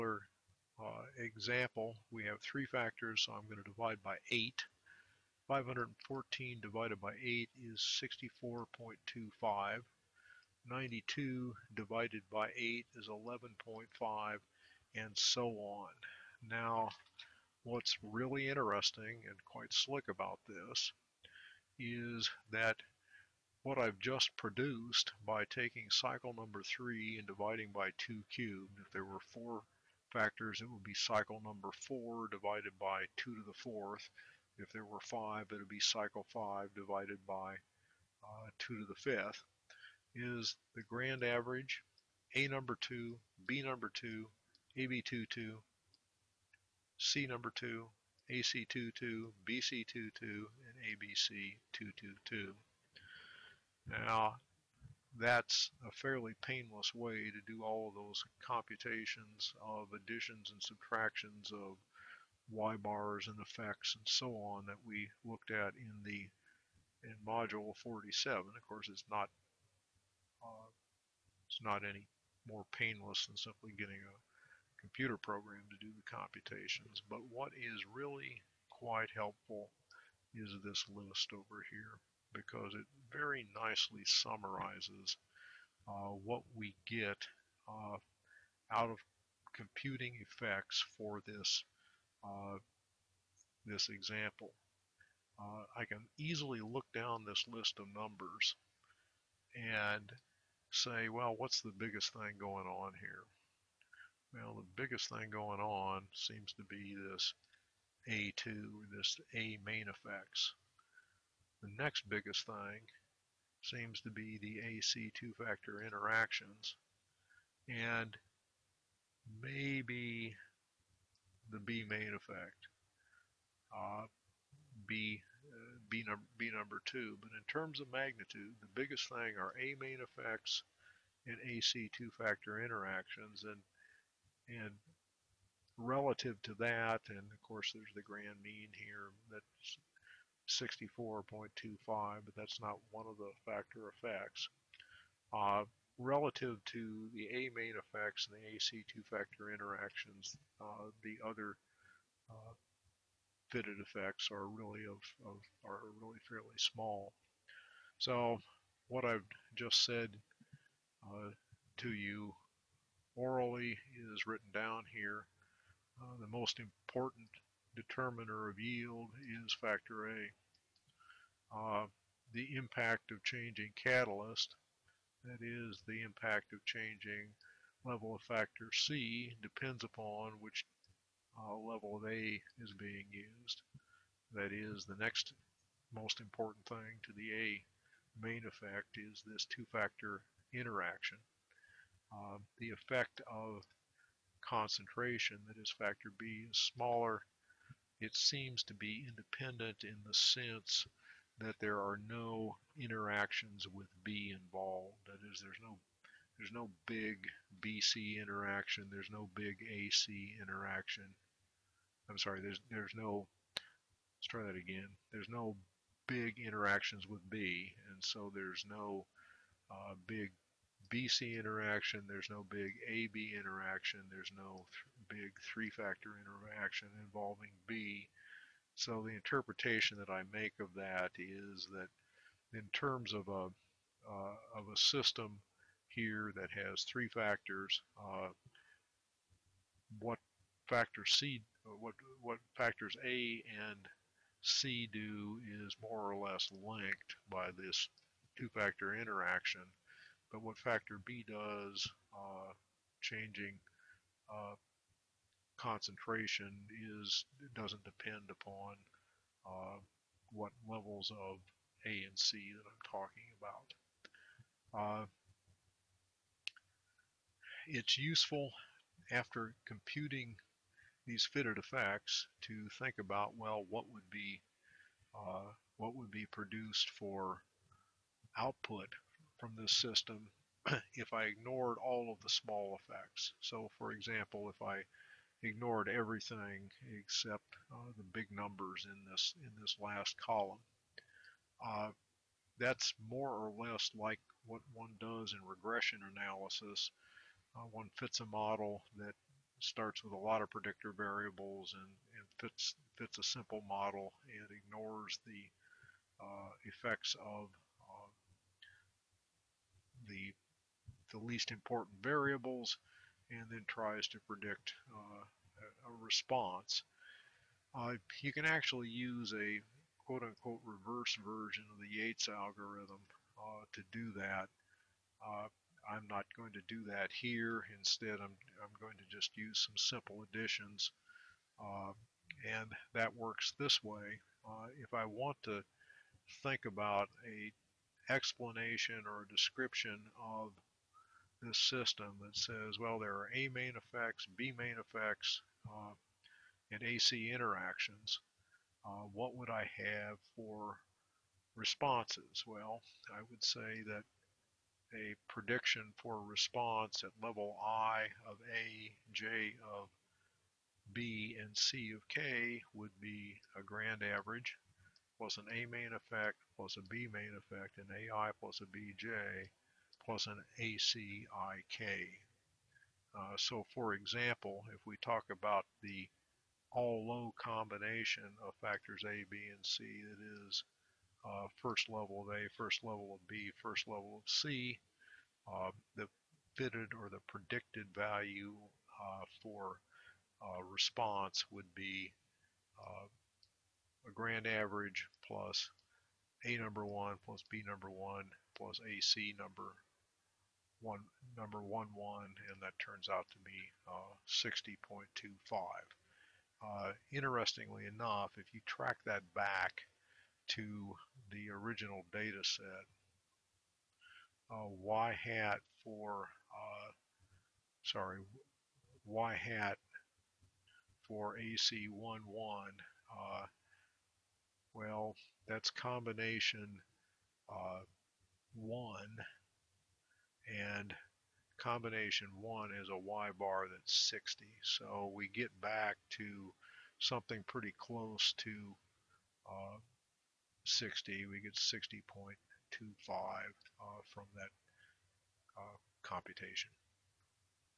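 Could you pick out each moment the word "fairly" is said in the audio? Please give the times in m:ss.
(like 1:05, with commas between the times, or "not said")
0:55, 2:36.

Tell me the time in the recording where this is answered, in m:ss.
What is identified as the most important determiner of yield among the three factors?
2:49.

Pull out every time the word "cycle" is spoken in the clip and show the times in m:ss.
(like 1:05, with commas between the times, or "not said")
0:25, 0:30, 0:35.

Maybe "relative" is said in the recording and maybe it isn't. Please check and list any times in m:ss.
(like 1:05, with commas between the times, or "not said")
2:15, 2:25.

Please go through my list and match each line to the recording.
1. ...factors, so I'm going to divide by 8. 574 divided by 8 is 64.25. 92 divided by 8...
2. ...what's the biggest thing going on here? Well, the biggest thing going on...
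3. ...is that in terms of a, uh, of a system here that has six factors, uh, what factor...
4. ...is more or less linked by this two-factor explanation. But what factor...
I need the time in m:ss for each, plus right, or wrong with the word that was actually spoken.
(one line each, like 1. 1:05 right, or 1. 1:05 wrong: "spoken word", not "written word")
1. 0:02 wrong: "514", not "574"
2. 1:41 right
3. 3:51 wrong: "three", not "six"
4. 4:05 wrong: "interaction", not "explanation".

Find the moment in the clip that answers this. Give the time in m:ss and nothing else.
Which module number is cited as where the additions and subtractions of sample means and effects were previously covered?
1:07.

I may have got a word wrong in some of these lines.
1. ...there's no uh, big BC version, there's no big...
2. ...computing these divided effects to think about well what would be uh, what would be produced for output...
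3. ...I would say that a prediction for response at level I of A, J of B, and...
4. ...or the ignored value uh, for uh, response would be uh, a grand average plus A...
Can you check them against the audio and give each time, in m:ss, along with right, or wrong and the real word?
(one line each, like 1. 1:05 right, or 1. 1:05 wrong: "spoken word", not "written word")
1. 3:38 wrong: "interaction", not "version"
2. 4:29 wrong: "fitted", not "divided"
3. 5:53 right
4. 6:26 wrong: "predicted", not "ignored".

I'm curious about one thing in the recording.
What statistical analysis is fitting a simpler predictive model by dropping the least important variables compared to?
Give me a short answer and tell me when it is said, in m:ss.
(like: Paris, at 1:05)
regression analysis, at 4:55.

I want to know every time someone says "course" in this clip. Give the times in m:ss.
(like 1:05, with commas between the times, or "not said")
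1:08, 2:17.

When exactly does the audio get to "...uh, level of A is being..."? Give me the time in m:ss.
3:01.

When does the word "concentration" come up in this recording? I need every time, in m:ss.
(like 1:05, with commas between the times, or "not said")
3:14, 4:15.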